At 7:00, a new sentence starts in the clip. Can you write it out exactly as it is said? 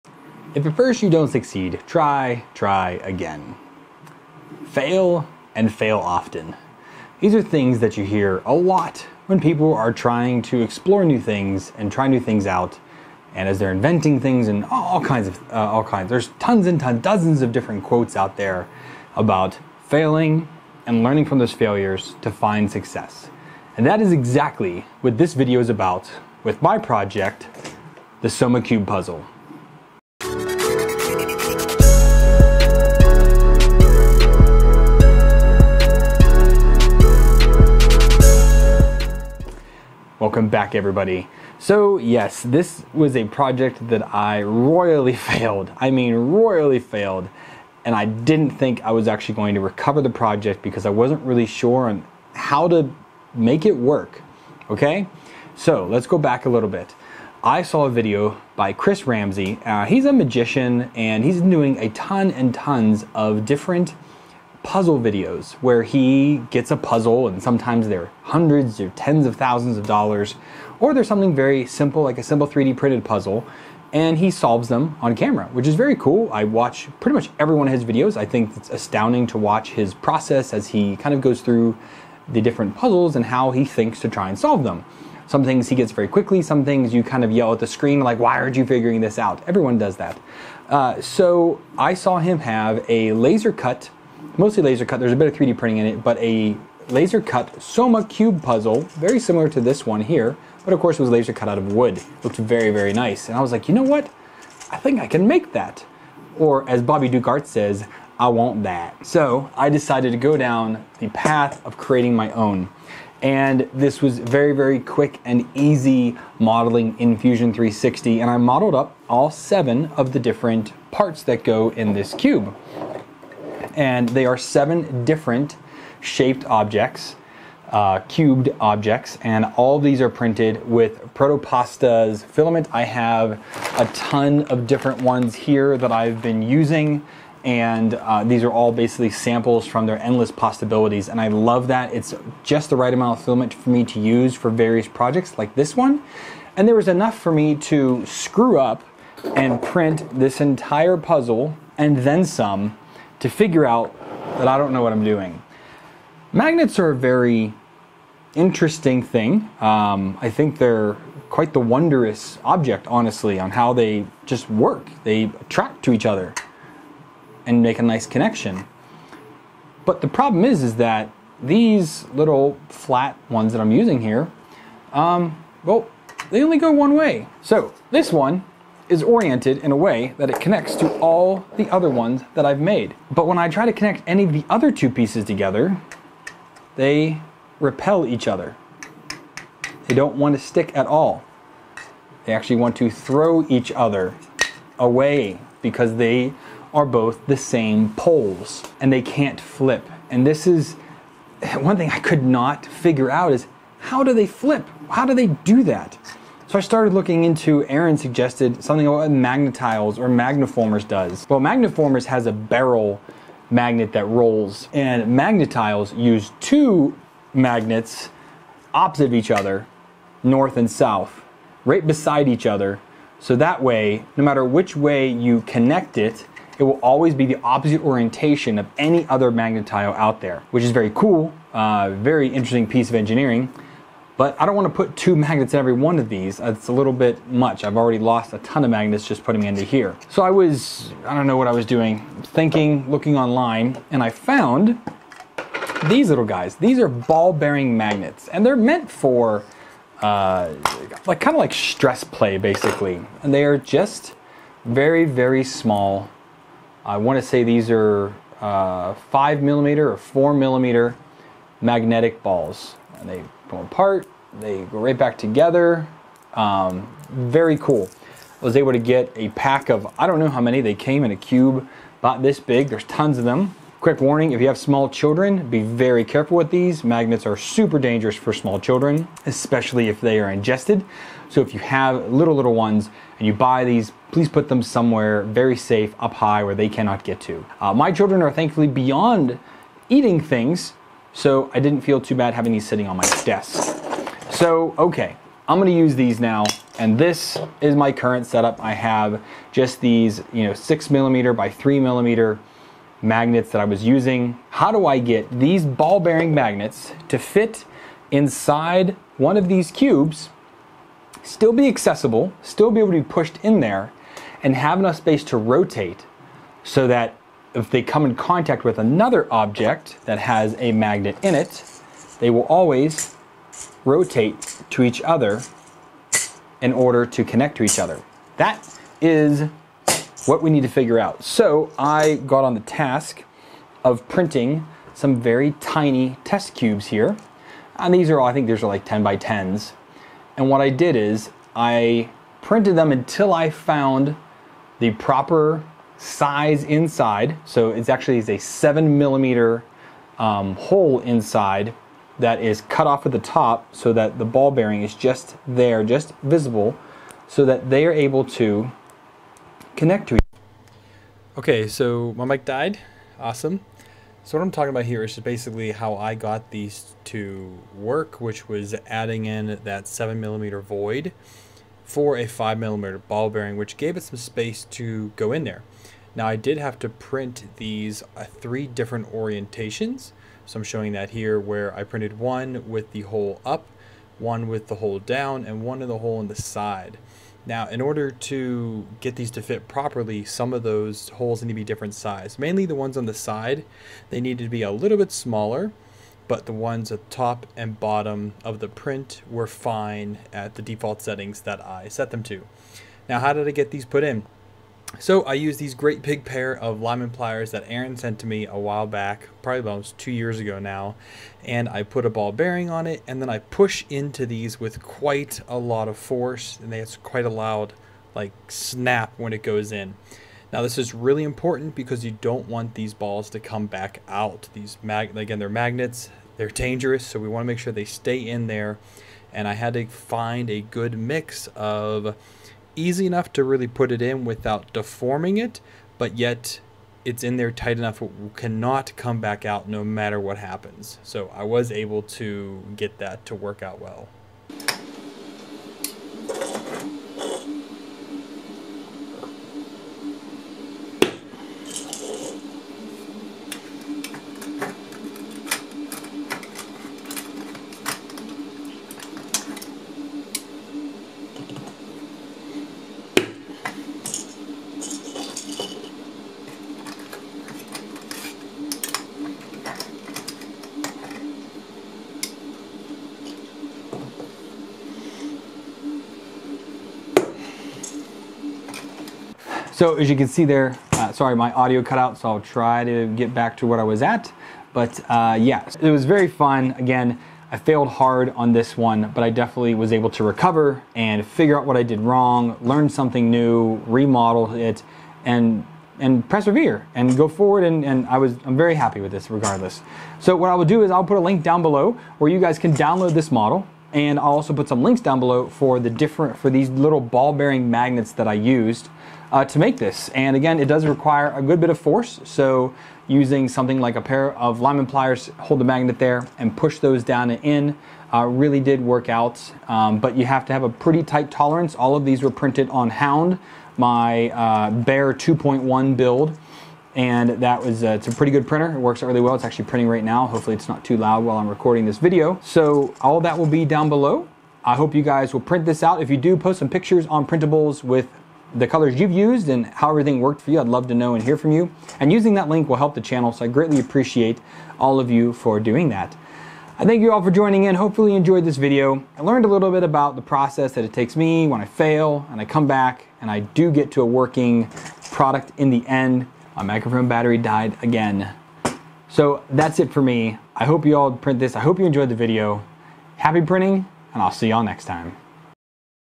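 Now this is really important because you don't want these balls to come back out.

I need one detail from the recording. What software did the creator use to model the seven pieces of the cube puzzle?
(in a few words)
Fusion 360.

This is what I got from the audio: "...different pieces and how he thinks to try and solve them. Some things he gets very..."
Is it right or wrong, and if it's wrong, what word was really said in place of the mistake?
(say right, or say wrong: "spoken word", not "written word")
wrong: "puzzles", not "pieces".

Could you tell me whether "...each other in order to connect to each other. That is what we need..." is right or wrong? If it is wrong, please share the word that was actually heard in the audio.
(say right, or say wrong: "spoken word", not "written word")
right.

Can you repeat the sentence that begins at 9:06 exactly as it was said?
I thank you all for joining in.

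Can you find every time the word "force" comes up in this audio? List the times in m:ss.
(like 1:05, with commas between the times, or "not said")
6:55, 8:31.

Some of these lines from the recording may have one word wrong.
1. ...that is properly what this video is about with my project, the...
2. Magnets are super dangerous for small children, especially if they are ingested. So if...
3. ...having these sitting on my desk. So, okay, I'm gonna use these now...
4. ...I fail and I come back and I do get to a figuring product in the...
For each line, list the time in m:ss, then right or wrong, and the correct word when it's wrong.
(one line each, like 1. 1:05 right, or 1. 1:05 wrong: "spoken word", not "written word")
1. 0:23 wrong: "exactly", not "properly"
2. 4:36 right
3. 4:52 right
4. 9:11 wrong: "working", not "figuring".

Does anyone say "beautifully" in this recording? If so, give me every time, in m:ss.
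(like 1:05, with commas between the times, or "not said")
not said.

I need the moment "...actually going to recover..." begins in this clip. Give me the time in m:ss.
0:49.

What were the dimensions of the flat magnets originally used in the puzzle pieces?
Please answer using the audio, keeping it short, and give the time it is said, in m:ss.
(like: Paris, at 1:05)
6mm by 3mm, at 5:00.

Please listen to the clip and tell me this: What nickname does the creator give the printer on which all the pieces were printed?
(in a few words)
Hound.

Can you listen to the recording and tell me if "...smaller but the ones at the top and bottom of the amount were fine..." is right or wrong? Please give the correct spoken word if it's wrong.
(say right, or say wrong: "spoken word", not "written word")
wrong: "print", not "amount".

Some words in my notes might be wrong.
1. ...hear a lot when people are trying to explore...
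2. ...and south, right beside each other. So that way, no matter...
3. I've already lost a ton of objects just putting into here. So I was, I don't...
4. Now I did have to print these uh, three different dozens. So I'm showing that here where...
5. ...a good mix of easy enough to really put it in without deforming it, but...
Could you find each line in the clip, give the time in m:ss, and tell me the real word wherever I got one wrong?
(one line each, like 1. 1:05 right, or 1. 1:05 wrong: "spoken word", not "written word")
1. 0:08 right
2. 3:40 right
3. 3:57 wrong: "magnets", not "objects"
4. 6:16 wrong: "orientations", not "dozens"
5. 7:10 right.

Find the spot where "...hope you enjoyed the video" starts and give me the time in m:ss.
9:21.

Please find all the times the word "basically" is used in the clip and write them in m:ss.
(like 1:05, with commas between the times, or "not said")
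2:18, 4:12, 6:05.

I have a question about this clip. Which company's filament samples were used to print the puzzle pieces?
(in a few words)
Protopasta.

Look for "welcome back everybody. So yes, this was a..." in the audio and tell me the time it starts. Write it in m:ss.
0:40.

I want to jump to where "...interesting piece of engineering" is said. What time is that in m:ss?
3:52.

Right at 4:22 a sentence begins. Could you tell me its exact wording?
And they go apart, they go right back together.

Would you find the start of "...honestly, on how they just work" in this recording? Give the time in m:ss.
2:42.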